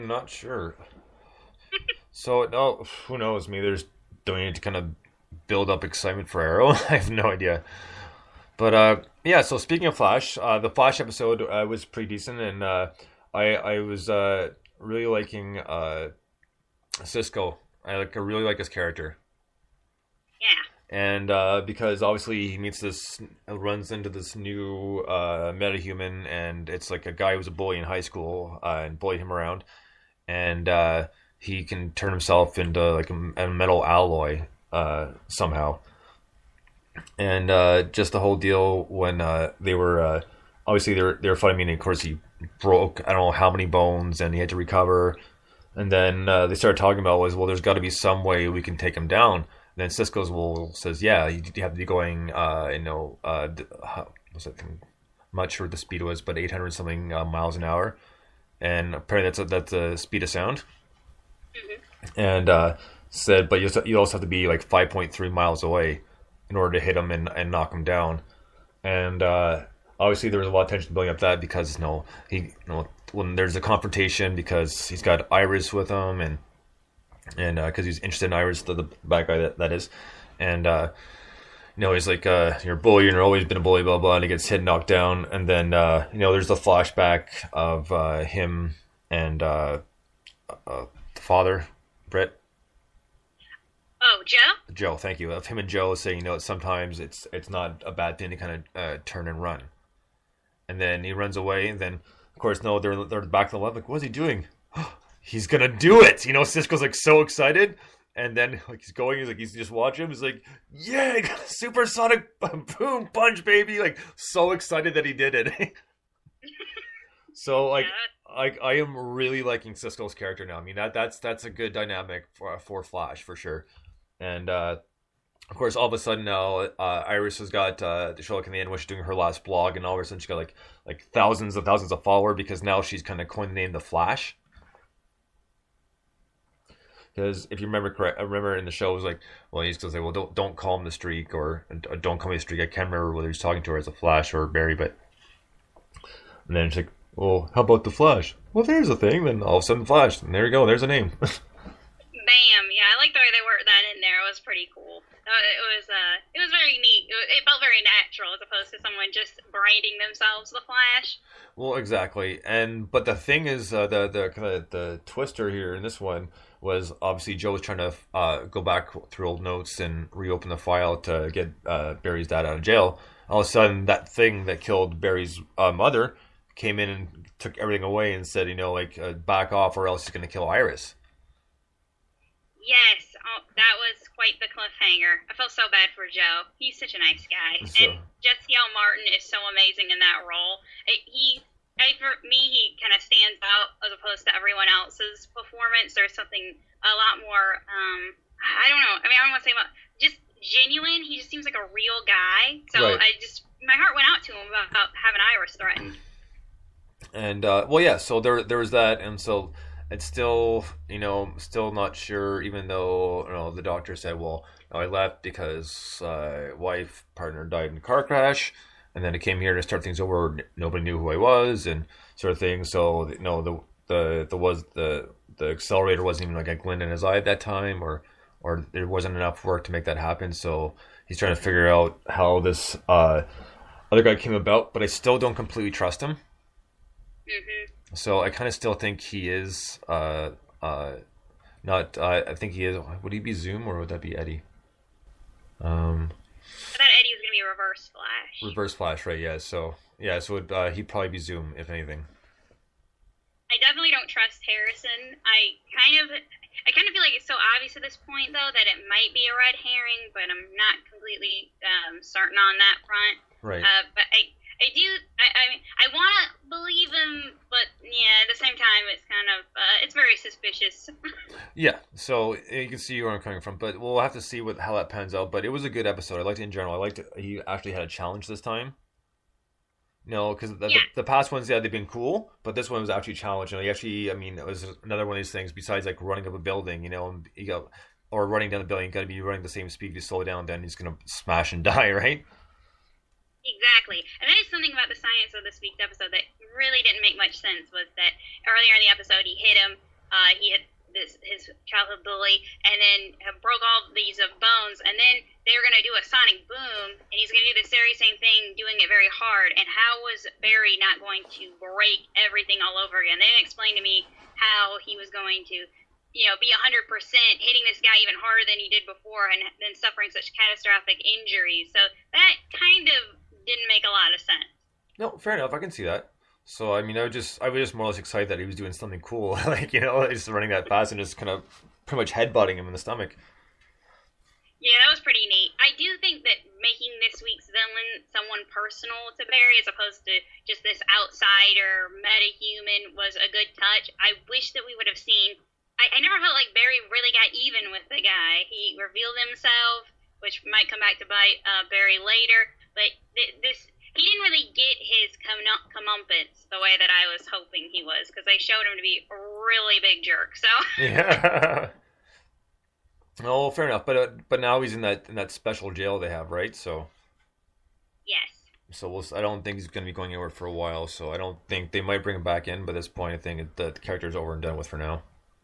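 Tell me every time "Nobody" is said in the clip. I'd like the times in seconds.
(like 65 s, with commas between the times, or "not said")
220 s.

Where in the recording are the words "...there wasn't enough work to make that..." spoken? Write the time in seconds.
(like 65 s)
228 s.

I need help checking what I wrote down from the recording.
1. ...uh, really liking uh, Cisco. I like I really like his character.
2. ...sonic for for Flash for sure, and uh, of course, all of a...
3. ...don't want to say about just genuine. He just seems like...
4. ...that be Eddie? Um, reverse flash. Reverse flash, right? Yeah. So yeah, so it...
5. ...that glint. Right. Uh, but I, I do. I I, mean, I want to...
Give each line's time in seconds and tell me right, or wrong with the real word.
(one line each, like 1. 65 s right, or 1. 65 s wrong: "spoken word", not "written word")
1. 14 s right
2. 121 s wrong: "dynamic", not "sonic"
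3. 199 s right
4. 243 s right
5. 262 s wrong: "front", not "glint".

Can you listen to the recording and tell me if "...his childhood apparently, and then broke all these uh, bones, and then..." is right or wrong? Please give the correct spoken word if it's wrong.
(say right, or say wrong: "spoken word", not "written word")
wrong: "bully", not "apparently".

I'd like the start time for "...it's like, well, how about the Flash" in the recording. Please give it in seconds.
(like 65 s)
146 s.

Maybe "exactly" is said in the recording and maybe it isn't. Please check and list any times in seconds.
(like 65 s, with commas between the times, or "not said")
161 s, 293 s.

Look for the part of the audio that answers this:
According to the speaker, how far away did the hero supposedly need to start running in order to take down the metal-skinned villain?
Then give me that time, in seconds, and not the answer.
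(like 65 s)
64 s.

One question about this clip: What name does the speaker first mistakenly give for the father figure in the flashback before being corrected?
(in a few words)
Brett.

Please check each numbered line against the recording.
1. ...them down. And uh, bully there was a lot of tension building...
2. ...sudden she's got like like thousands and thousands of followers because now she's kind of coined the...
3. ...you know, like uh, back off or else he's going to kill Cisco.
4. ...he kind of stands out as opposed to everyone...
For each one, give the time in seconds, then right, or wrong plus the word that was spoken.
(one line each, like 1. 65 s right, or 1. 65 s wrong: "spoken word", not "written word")
1. 67 s wrong: "obviously", not "bully"
2. 130 s right
3. 178 s wrong: "Iris", not "Cisco"
4. 192 s right.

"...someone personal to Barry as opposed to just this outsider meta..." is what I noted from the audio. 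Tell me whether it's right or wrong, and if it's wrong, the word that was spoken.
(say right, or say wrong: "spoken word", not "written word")
right.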